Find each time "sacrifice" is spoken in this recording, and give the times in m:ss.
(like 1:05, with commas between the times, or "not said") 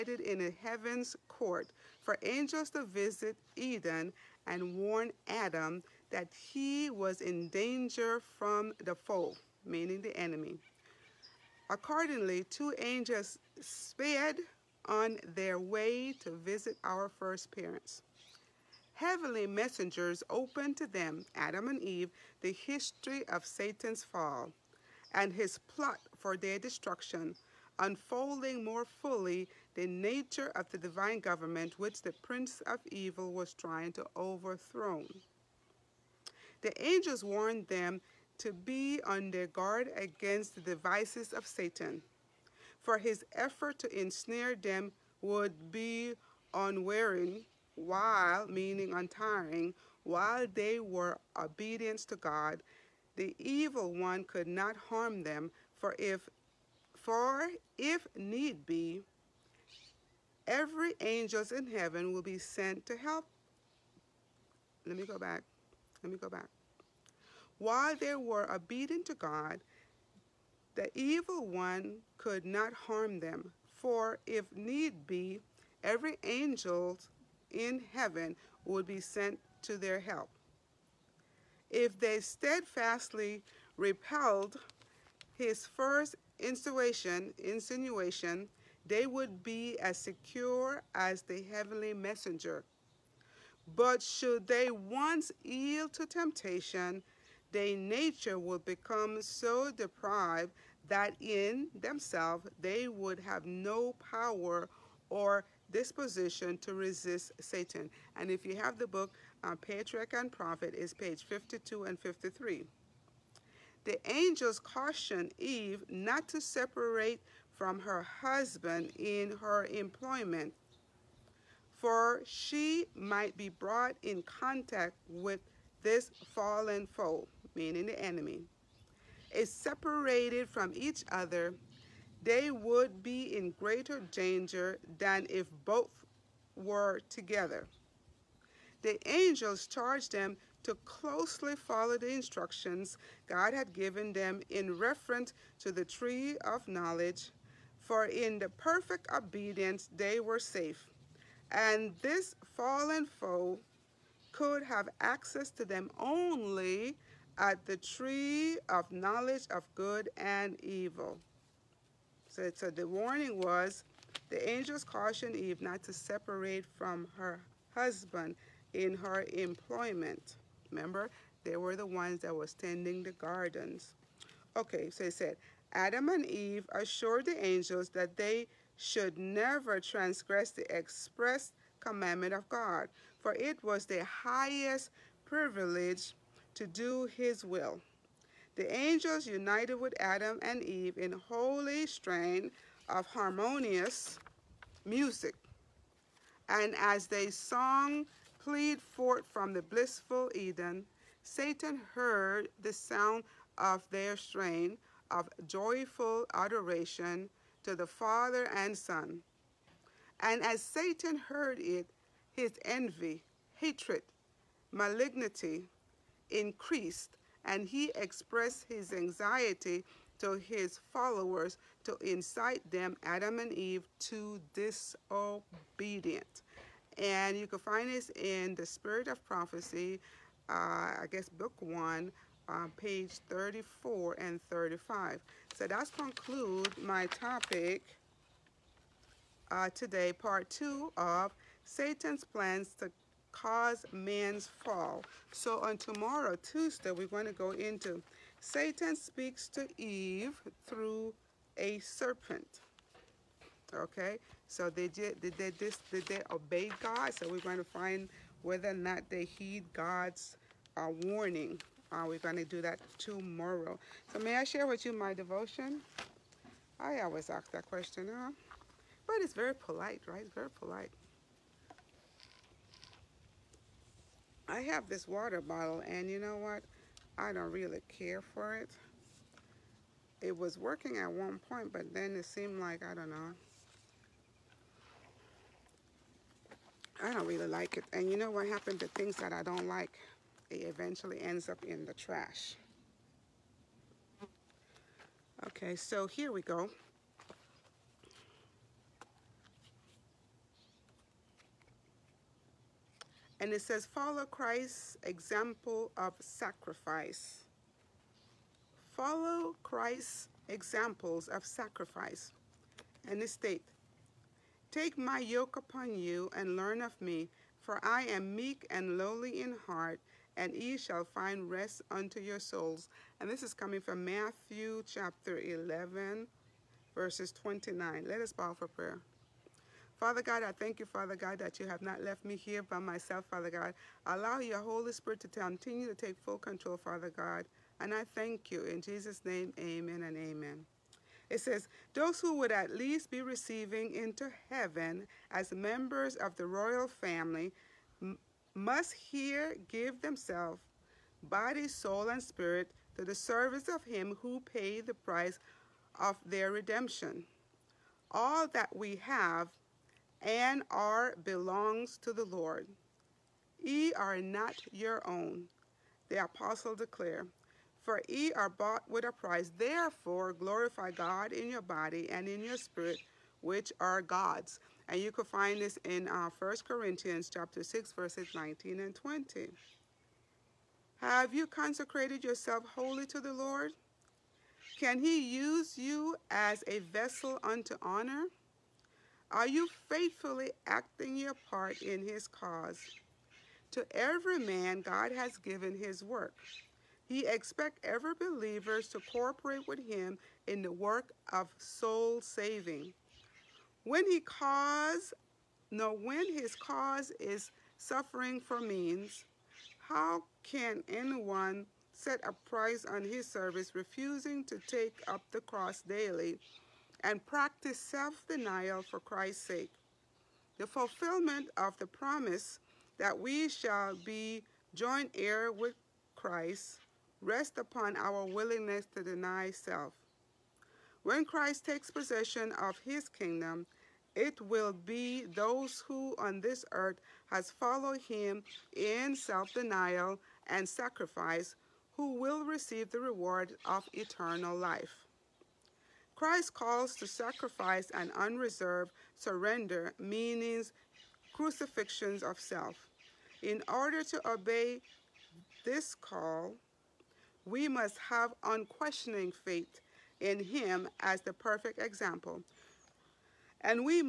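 5:06, 5:11, 7:20, 7:27.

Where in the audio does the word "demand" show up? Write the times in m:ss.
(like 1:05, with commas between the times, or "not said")
not said.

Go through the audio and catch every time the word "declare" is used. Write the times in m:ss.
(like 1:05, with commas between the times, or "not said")
6:06.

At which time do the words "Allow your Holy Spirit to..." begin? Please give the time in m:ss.
5:34.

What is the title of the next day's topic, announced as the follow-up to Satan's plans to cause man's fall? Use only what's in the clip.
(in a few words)
Satan speaks to Eve through a serpent.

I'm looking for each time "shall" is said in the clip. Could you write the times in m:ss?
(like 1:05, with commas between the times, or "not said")
5:20, 7:03.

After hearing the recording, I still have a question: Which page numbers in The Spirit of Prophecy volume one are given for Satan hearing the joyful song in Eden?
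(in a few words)
34 and 35.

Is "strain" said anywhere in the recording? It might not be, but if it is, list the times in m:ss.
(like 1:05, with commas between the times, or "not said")
3:11, 3:24.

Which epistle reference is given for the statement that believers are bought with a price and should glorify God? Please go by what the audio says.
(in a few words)
1 Corinthians 6:19-20.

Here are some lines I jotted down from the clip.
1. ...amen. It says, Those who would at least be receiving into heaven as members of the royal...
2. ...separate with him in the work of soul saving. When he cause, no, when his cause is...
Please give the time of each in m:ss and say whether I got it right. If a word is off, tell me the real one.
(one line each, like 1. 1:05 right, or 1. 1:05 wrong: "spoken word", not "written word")
1. 5:40 right
2. 6:39 wrong: "cooperate", not "separate".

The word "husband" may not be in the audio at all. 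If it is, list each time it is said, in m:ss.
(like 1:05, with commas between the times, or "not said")
1:58, 2:47.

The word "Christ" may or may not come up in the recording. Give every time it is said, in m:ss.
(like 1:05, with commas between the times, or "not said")
5:04, 5:09, 6:58, 7:06, 7:11, 7:26.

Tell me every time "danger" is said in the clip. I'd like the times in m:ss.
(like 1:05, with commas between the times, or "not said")
0:07, 2:14.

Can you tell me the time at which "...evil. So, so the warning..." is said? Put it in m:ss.
2:40.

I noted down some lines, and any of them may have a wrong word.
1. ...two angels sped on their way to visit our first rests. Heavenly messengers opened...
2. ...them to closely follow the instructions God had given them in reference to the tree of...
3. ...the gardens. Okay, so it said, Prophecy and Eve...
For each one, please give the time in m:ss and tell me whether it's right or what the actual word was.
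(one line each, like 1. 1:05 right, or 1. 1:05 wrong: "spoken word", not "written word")
1. 0:12 wrong: "parents", not "rests"
2. 2:20 right
3. 2:53 wrong: "Adam", not "Prophecy".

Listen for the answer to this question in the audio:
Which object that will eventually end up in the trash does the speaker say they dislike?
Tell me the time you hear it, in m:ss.
4:35.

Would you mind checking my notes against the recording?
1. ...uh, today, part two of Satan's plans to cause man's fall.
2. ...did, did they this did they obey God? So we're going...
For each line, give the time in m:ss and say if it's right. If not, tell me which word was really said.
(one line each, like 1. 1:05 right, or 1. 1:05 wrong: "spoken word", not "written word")
1. 3:59 right
2. 4:14 right.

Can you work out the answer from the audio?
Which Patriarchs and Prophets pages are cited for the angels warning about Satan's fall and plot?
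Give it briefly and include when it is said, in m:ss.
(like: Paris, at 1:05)
52 and 53, at 1:50.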